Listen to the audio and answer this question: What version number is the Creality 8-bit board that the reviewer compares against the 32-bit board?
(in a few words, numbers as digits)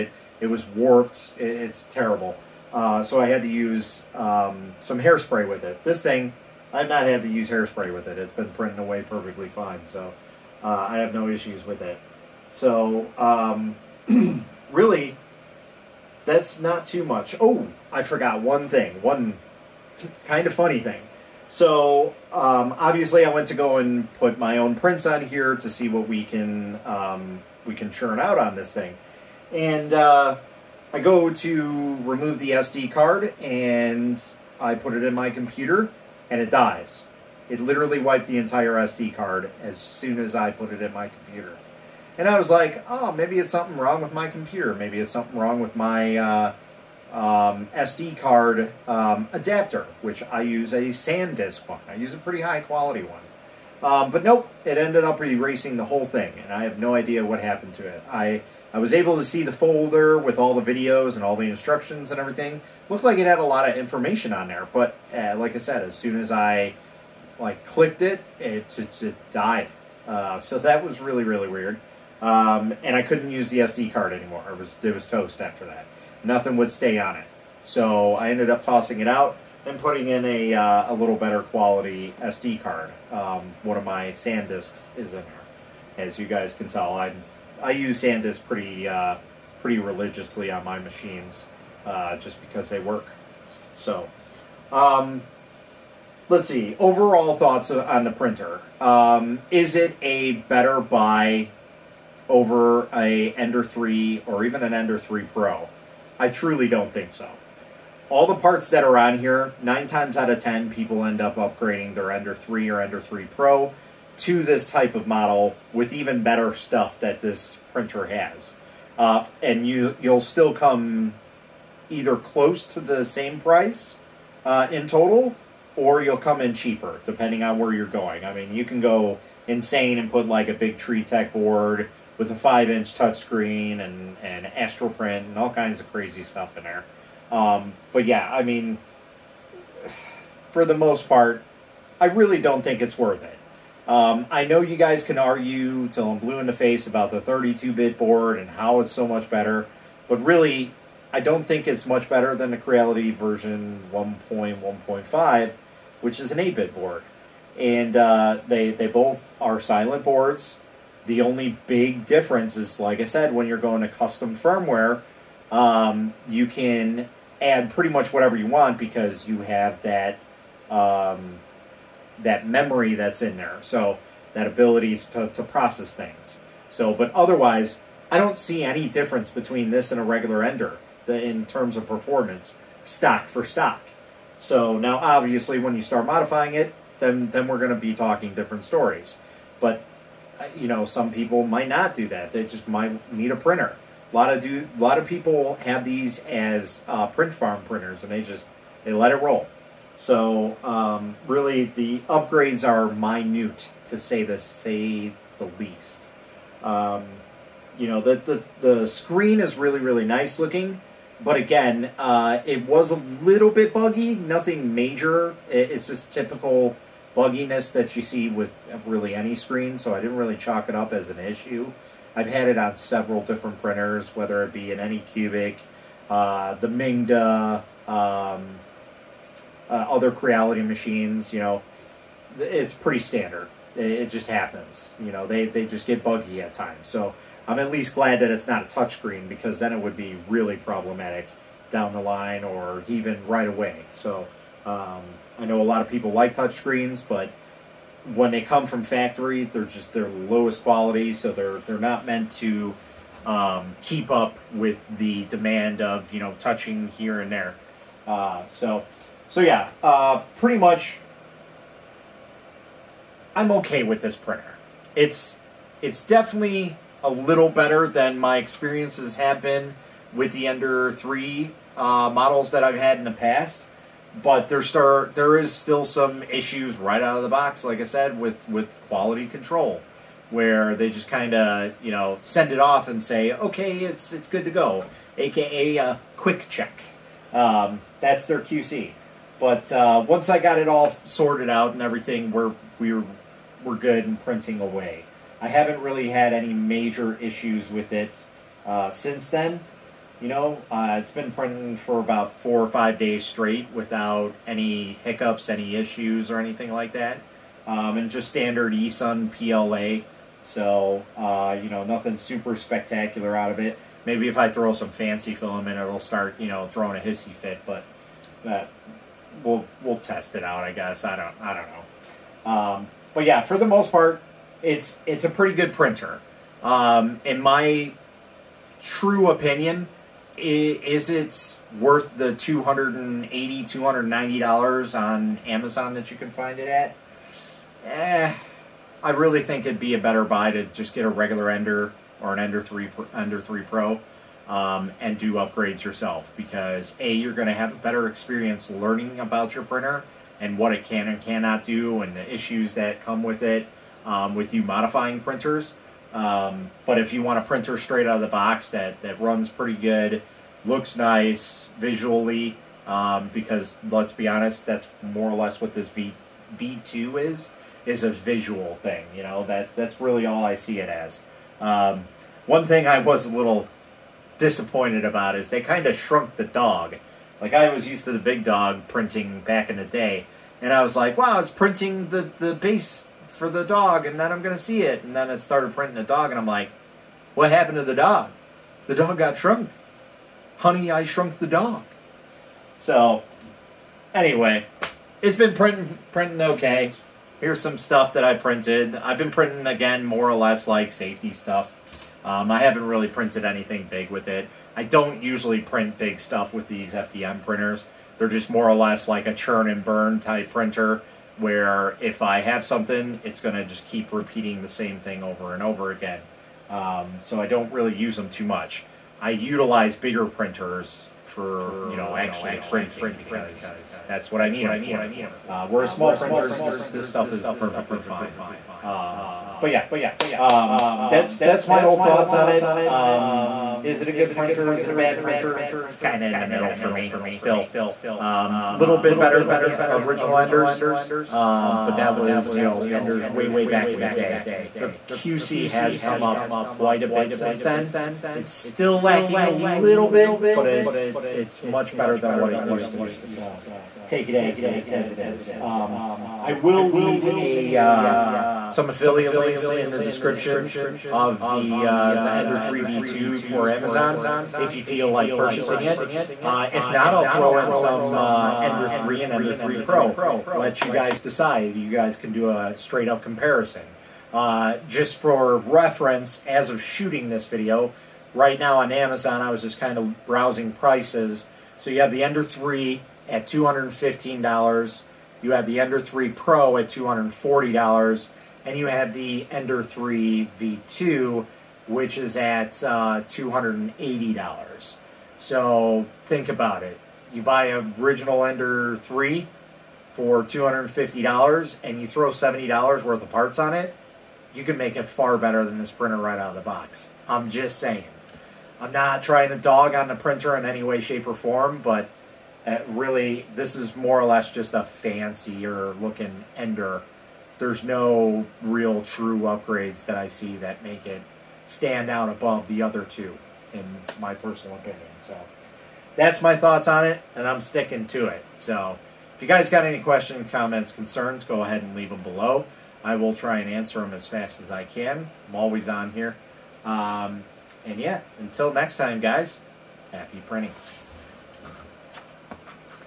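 1.1.5.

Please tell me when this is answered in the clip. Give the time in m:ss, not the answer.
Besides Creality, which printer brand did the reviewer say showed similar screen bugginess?
3:46.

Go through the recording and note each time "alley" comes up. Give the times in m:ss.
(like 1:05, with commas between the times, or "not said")
not said.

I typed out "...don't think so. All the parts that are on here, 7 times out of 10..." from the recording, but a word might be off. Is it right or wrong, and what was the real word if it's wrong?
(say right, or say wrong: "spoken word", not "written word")
wrong: "9", not "7".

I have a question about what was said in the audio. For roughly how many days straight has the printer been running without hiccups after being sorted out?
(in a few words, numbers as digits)
4 or 5 days.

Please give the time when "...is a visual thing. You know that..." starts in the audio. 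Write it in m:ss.
6:07.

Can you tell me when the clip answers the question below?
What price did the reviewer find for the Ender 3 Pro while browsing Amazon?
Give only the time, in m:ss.
8:06.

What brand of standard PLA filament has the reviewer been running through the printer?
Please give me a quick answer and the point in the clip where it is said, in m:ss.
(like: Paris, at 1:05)
eSUN, at 5:08.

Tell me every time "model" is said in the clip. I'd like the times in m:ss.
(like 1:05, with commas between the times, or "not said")
1:55, 4:32.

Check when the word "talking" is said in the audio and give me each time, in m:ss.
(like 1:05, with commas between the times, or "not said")
3:07.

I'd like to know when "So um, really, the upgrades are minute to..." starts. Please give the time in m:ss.
3:19.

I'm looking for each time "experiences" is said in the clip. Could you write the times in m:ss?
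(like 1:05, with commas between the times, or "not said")
4:28, 5:48.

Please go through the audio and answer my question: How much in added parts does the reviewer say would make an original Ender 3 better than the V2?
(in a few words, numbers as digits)
$70.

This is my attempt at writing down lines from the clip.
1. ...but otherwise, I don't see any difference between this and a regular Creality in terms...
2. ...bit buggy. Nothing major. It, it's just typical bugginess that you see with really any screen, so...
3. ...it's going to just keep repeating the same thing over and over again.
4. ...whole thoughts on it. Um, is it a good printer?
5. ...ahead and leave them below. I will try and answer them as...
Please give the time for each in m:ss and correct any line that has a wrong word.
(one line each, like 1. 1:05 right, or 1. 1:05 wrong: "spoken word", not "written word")
1. 2:56 wrong: "Ender", not "Creality"
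2. 3:33 right
3. 6:53 right
4. 7:11 right
5. 8:51 right.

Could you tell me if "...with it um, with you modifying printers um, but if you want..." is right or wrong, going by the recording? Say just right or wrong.
right.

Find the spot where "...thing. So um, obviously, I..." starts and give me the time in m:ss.
0:20.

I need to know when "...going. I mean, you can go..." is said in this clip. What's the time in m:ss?
2:07.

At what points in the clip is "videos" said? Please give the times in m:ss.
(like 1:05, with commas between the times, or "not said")
1:00, 7:57.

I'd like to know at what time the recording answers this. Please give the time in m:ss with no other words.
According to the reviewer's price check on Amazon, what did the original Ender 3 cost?
8:03.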